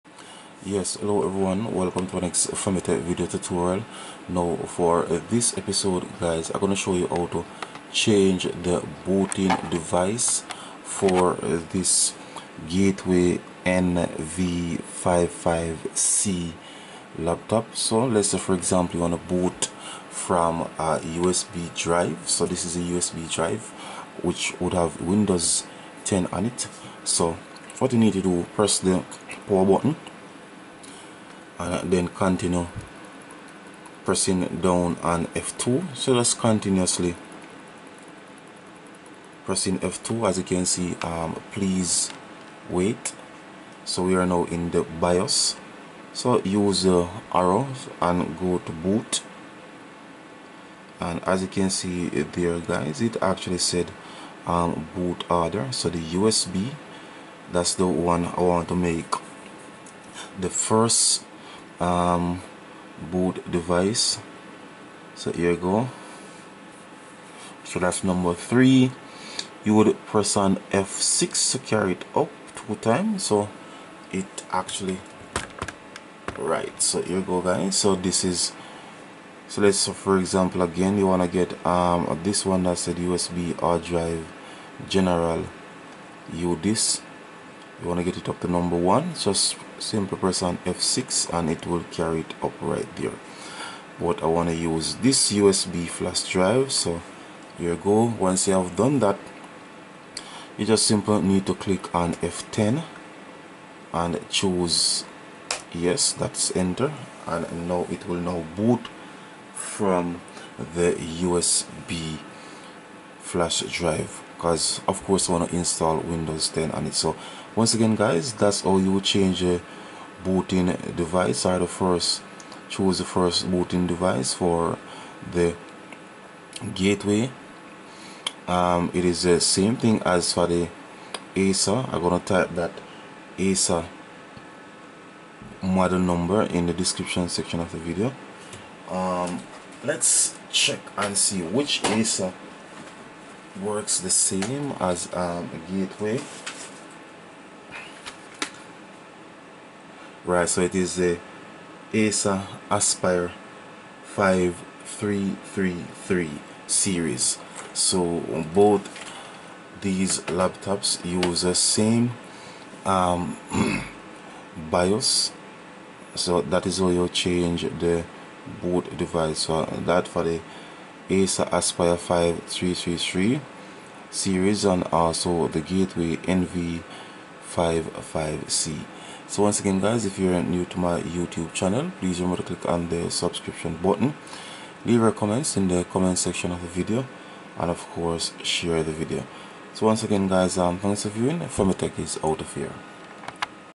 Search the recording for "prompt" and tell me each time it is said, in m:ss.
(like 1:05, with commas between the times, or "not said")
not said.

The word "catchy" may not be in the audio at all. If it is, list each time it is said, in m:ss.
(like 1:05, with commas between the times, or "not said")
not said.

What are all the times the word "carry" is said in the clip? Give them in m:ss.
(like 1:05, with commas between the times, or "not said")
1:11, 1:31.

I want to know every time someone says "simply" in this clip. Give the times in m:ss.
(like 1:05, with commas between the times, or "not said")
1:29, 1:40.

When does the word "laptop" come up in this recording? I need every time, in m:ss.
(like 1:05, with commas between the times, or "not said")
0:17, 2:40.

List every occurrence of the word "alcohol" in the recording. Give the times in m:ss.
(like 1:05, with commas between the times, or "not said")
not said.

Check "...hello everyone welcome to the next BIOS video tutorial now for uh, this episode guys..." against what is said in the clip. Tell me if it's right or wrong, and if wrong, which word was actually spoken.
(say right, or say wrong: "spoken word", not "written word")
wrong: "FEMITECH", not "BIOS".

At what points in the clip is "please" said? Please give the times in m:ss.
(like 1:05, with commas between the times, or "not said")
0:41, 3:01.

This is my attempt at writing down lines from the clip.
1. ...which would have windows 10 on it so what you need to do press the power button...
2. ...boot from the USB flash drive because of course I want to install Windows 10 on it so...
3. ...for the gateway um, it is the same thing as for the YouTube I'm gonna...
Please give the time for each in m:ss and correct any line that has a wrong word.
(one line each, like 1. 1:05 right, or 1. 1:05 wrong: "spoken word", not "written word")
1. 0:24 right
2. 1:48 right
3. 2:04 wrong: "Acer", not "YouTube".